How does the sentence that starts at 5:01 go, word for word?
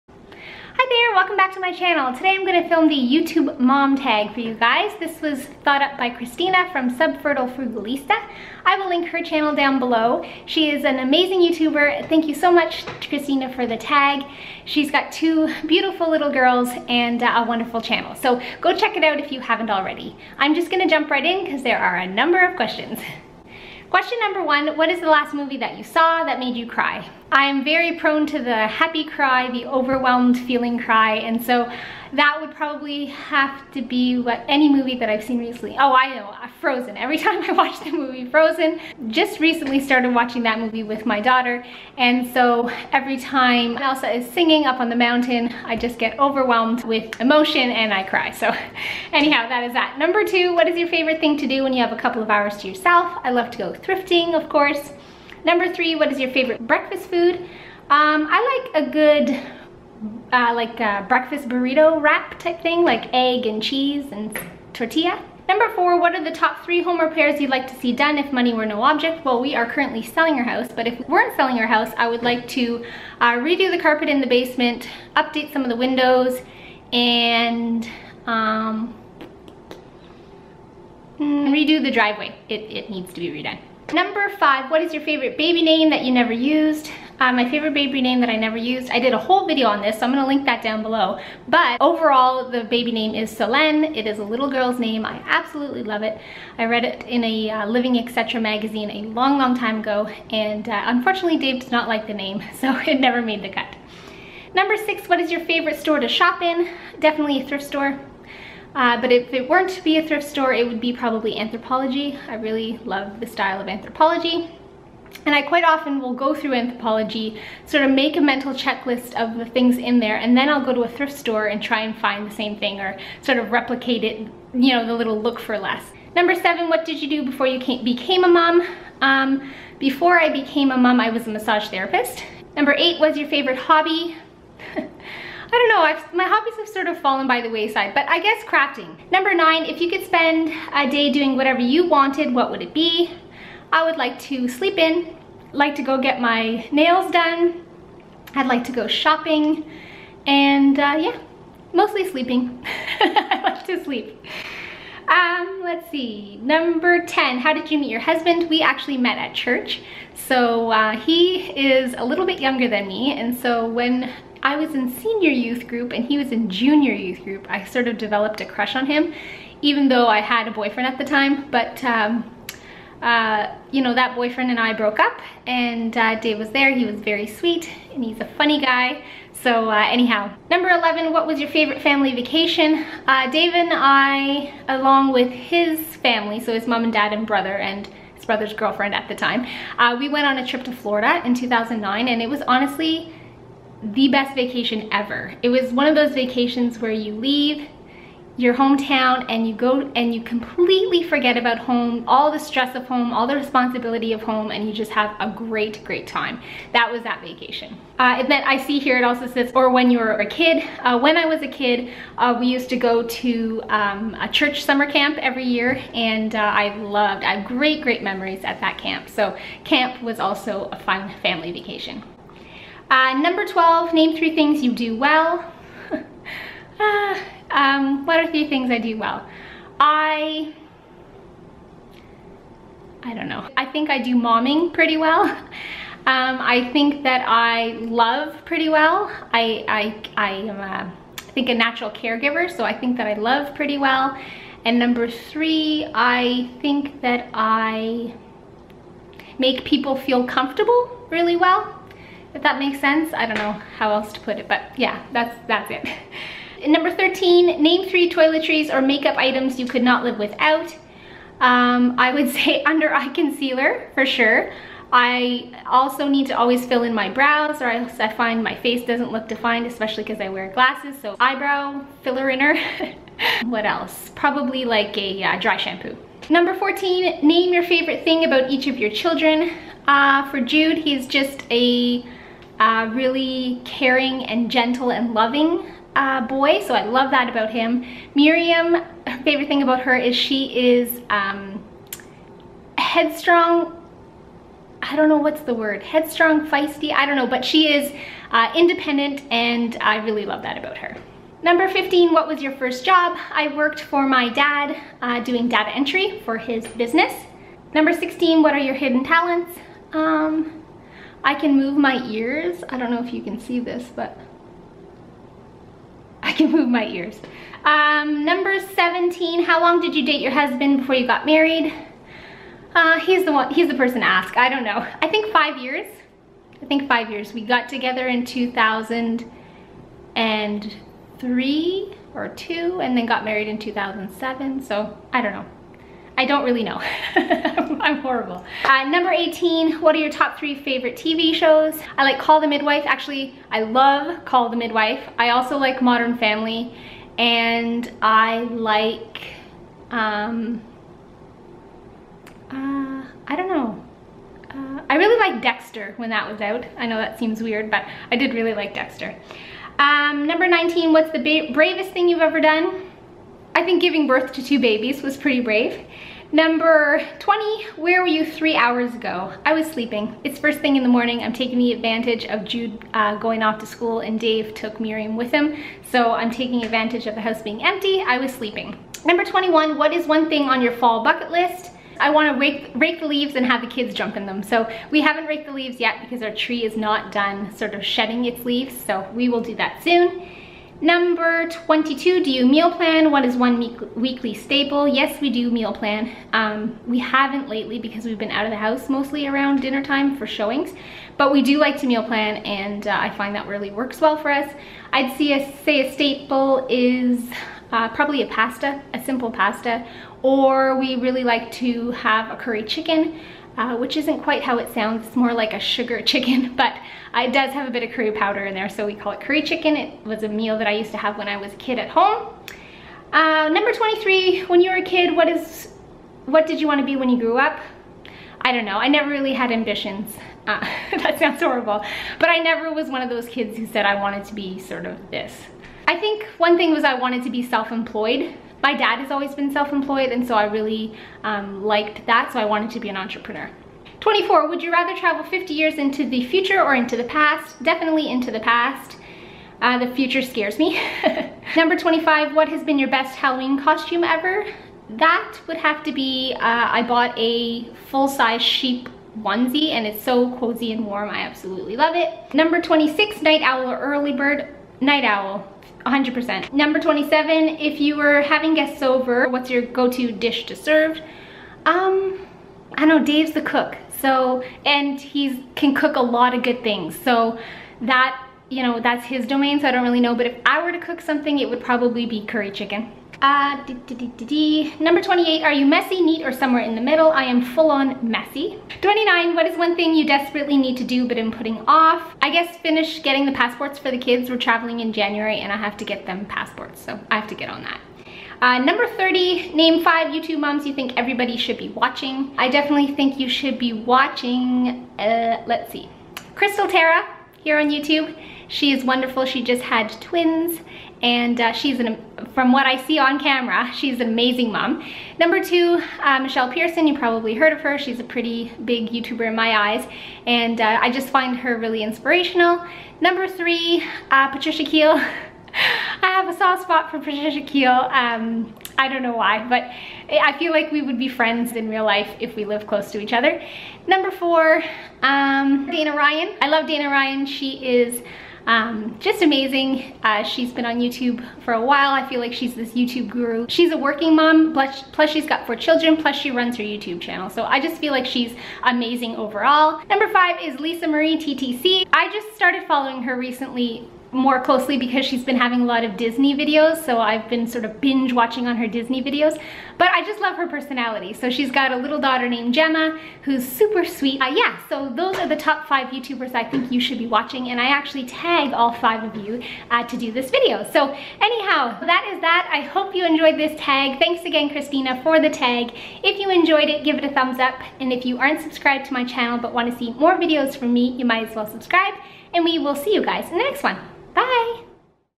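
Number 15, what was your first job?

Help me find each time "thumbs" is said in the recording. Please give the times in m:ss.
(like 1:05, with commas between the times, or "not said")
9:37.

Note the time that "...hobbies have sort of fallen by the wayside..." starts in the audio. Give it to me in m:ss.
2:16.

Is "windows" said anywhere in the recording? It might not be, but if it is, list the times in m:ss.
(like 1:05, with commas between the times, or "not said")
1:15.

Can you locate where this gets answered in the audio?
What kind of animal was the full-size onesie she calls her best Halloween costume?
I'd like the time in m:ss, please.
7:38.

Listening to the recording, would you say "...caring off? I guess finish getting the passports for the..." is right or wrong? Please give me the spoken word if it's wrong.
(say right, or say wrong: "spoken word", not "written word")
wrong: "putting", not "caring".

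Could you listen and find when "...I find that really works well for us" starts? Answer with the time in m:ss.
6:42.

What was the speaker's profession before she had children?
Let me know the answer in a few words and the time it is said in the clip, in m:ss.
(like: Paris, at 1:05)
massage therapist, at 2:11.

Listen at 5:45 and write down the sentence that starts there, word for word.
I also like Modern Family and I like, um, uh, I don't know.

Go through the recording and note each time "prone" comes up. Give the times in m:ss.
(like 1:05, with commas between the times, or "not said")
0:27.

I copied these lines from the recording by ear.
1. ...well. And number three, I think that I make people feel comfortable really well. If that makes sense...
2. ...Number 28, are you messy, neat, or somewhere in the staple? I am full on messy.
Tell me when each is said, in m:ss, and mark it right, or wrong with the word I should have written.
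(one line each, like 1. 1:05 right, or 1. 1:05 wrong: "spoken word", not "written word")
1. 4:03 right
2. 8:04 wrong: "middle", not "staple".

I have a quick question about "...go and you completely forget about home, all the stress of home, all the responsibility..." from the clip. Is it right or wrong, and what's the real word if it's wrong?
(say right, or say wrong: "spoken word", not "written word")
right.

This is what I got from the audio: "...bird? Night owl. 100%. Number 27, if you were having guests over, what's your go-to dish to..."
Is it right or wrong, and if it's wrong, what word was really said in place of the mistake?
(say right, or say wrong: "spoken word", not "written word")
right.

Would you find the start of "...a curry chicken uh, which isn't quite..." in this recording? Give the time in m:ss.
6:52.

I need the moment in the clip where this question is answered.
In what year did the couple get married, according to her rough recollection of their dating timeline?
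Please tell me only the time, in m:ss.
5:33.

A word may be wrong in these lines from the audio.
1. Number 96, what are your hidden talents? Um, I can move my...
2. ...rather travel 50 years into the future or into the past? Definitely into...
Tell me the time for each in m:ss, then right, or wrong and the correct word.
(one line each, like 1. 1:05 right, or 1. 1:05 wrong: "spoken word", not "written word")
1. 5:07 wrong: "16", not "96"
2. 7:24 right.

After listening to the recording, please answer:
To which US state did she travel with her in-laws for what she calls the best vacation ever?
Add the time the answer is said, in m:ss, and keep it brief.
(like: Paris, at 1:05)
Florida, at 3:10.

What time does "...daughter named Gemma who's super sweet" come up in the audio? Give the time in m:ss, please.
9:21.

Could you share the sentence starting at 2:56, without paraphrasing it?
He was very sweet and he's a funny guy.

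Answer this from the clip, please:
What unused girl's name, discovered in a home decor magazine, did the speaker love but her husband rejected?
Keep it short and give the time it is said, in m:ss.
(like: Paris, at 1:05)
Solène, at 1:33.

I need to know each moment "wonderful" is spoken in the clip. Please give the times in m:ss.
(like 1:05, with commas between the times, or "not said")
0:17, 8:28.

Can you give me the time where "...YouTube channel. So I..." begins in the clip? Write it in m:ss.
9:06.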